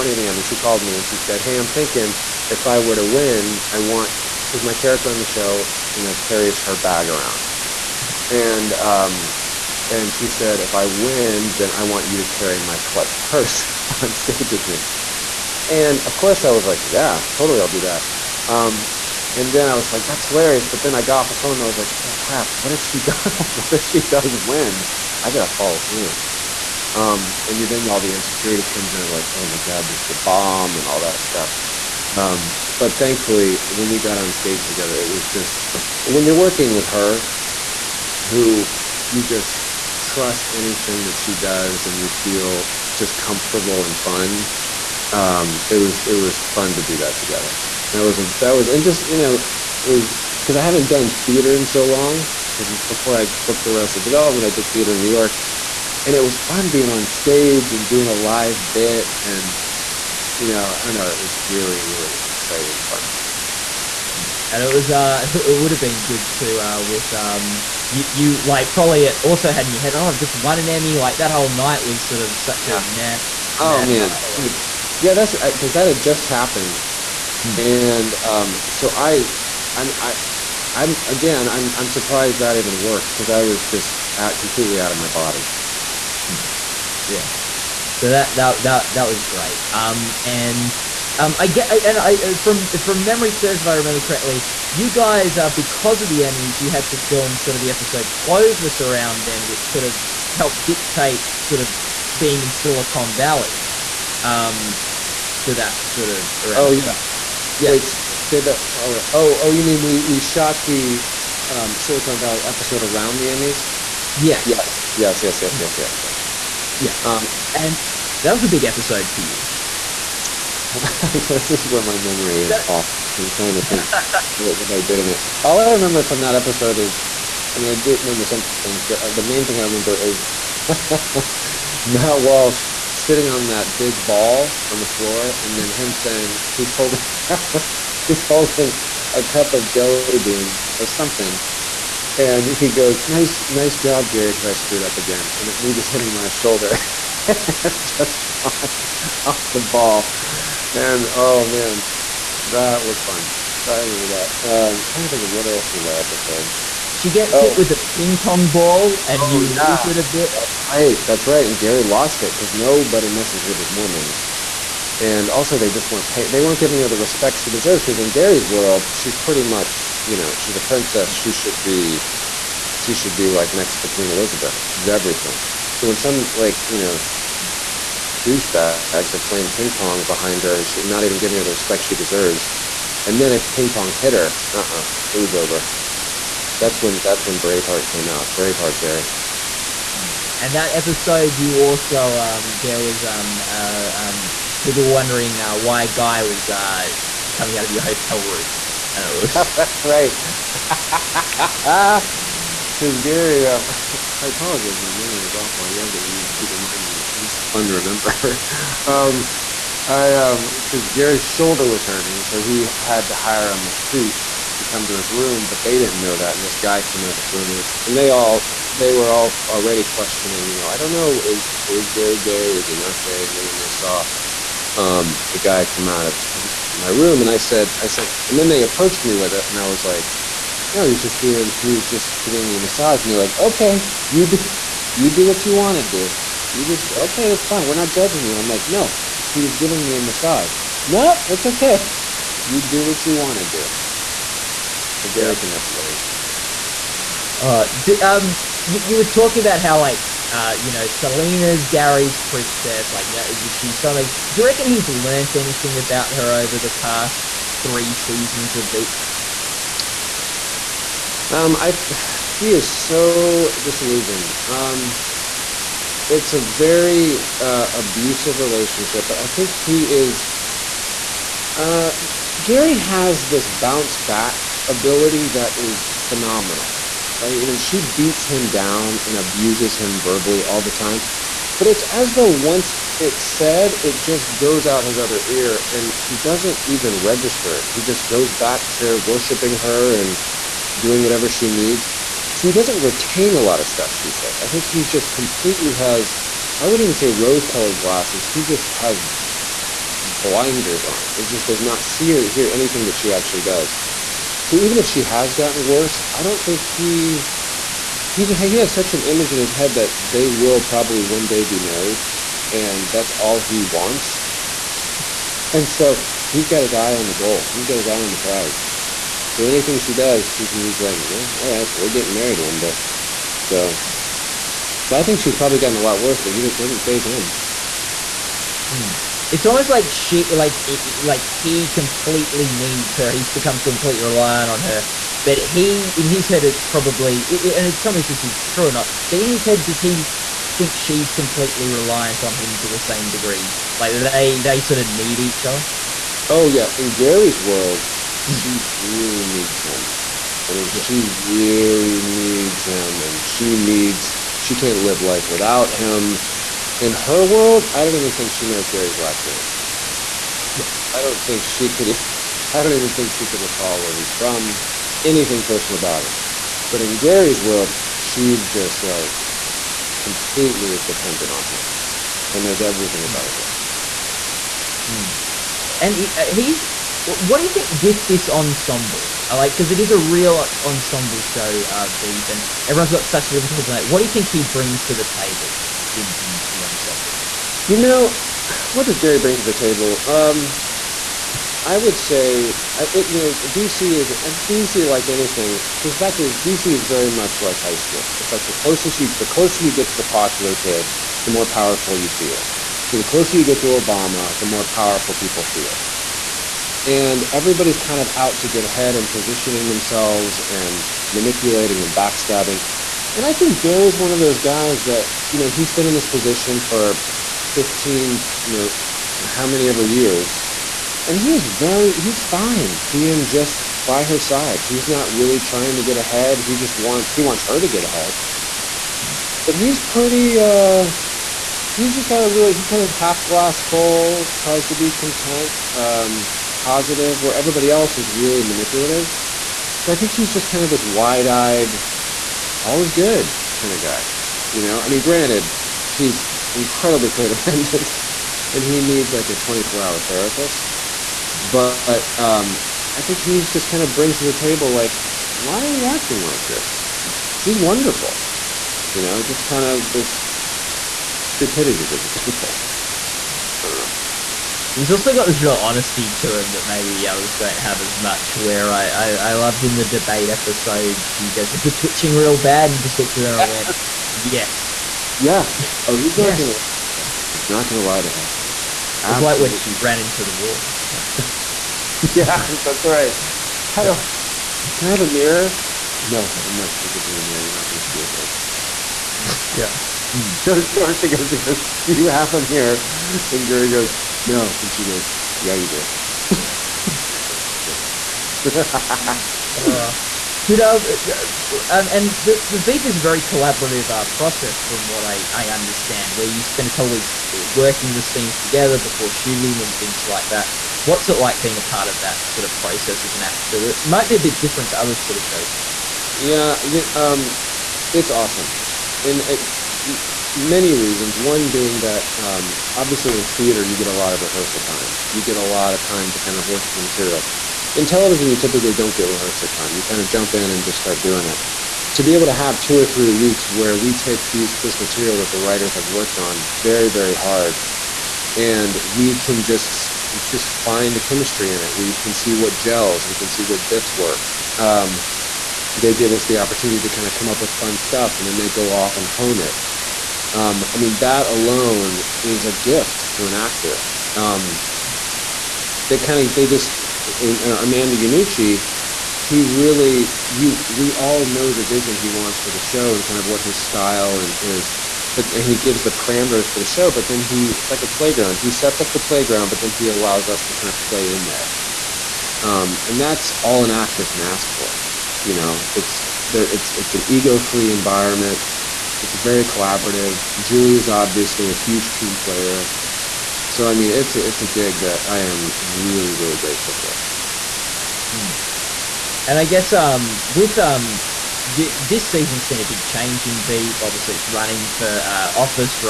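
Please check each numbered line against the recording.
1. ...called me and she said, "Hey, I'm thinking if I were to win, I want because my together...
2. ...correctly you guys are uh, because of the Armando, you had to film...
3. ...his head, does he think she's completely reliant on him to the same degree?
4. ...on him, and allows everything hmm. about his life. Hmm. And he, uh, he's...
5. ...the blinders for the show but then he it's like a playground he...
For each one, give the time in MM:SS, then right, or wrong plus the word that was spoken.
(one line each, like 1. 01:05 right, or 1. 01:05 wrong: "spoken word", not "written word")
1. 00:00 wrong: "character", not "together"
2. 01:34 wrong: "Emmys", not "Armando"
3. 05:39 right
4. 06:11 wrong: "knows", not "allows"
5. 09:25 wrong: "parameters", not "blinders".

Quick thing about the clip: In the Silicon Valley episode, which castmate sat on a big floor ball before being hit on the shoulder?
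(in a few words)
Matt Walsh.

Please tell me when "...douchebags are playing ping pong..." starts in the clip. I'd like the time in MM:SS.
02:58.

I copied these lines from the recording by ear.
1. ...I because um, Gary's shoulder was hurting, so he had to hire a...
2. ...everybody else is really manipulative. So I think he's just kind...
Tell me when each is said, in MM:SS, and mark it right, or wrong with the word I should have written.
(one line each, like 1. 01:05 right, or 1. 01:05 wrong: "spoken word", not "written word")
1. 03:29 right
2. 07:17 right.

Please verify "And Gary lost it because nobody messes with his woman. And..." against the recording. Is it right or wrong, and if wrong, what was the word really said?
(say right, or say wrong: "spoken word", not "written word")
right.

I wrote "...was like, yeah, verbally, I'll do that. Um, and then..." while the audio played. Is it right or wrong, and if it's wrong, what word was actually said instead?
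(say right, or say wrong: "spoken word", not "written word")
wrong: "totally", not "verbally".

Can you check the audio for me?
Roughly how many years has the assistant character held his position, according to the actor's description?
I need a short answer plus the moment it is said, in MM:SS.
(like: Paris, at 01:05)
15, at 06:57.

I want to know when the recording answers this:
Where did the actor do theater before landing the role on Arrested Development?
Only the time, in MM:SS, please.
00:55.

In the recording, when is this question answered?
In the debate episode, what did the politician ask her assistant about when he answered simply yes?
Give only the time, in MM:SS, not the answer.
07:51.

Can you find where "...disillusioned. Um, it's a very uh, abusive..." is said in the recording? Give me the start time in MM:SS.
04:23.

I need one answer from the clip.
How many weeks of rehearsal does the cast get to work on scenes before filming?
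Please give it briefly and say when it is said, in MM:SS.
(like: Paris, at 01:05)
2 or 3 weeks, at 08:52.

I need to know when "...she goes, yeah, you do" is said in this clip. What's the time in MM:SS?
08:14.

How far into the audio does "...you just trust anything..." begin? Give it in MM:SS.
00:39.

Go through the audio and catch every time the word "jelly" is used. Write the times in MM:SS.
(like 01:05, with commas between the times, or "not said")
02:19.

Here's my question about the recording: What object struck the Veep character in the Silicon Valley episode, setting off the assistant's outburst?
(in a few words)
A ping pong ball.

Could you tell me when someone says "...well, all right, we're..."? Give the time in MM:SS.
05:21.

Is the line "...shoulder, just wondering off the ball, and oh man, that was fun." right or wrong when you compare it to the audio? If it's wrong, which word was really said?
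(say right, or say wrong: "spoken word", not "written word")
wrong: "flying", not "wondering".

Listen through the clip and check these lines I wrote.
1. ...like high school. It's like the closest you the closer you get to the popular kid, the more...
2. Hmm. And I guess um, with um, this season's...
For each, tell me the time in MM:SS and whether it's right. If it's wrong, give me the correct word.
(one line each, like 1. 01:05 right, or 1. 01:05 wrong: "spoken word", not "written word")
1. 06:37 right
2. 09:48 right.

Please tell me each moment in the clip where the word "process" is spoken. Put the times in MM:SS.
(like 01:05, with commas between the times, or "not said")
08:24, 08:32.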